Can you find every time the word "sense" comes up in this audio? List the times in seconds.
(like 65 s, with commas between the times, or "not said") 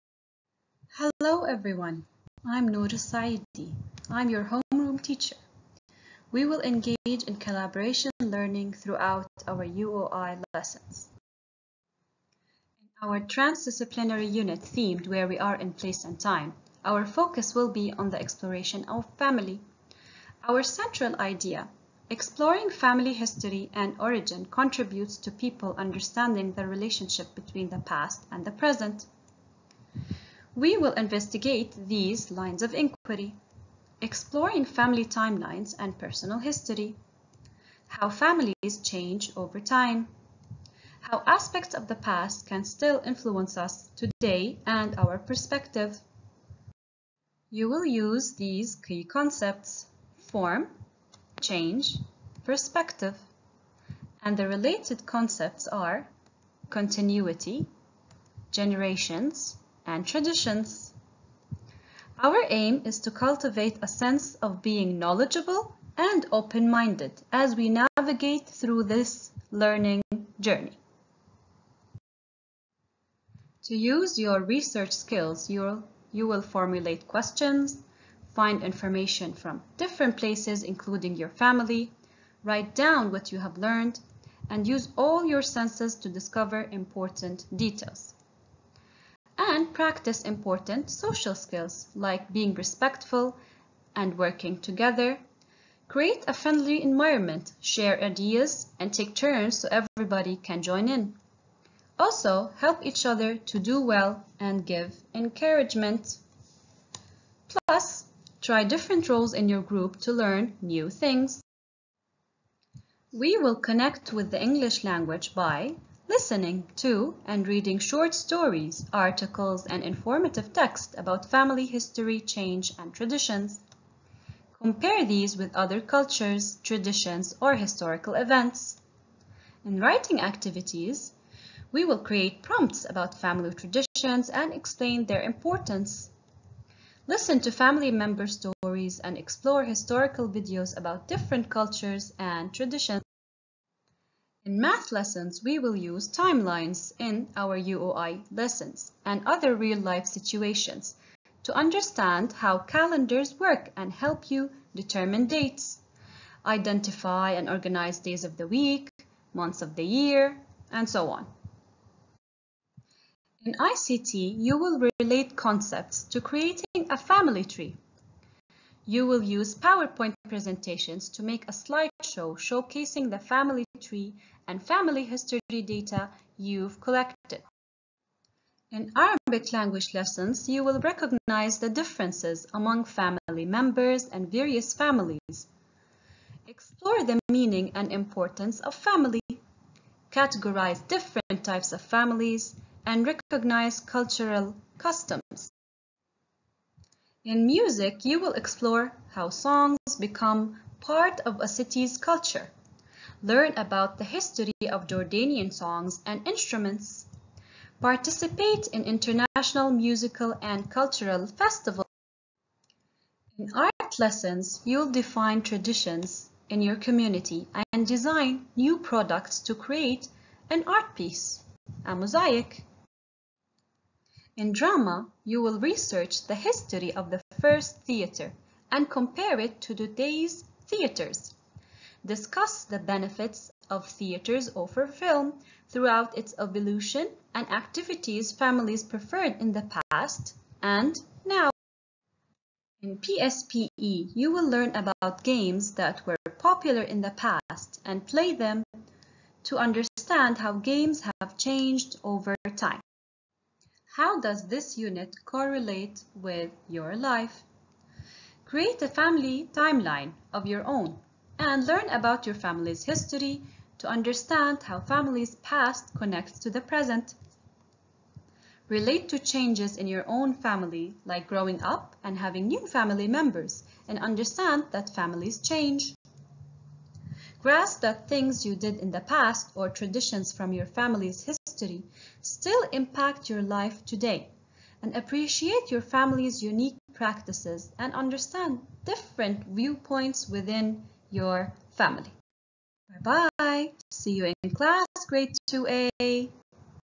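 63 s, 85 s.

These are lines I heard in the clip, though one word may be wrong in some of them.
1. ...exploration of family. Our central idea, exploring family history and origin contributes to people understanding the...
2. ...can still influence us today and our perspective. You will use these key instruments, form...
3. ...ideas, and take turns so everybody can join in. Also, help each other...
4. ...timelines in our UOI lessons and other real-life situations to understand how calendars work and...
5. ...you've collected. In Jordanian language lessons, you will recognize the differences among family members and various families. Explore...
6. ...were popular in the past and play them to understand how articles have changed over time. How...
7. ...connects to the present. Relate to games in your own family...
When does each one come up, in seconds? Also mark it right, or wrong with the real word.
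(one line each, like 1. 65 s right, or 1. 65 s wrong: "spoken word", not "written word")
1. 18 s right
2. 42 s wrong: "concepts", not "instruments"
3. 98 s right
4. 146 s right
5. 176 s wrong: "Arabic", not "Jordanian"
6. 246 s wrong: "games", not "articles"
7. 265 s wrong: "changes", not "games".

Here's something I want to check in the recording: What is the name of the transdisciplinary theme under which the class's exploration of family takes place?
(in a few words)
Where We Are in Place and Time.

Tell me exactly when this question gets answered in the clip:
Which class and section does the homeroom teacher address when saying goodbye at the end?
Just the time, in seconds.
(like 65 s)
295 s.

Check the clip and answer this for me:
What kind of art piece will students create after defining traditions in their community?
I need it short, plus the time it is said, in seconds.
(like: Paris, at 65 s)
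A mosaic, at 221 s.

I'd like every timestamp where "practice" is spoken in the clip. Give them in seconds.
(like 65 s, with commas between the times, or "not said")
89 s, 286 s.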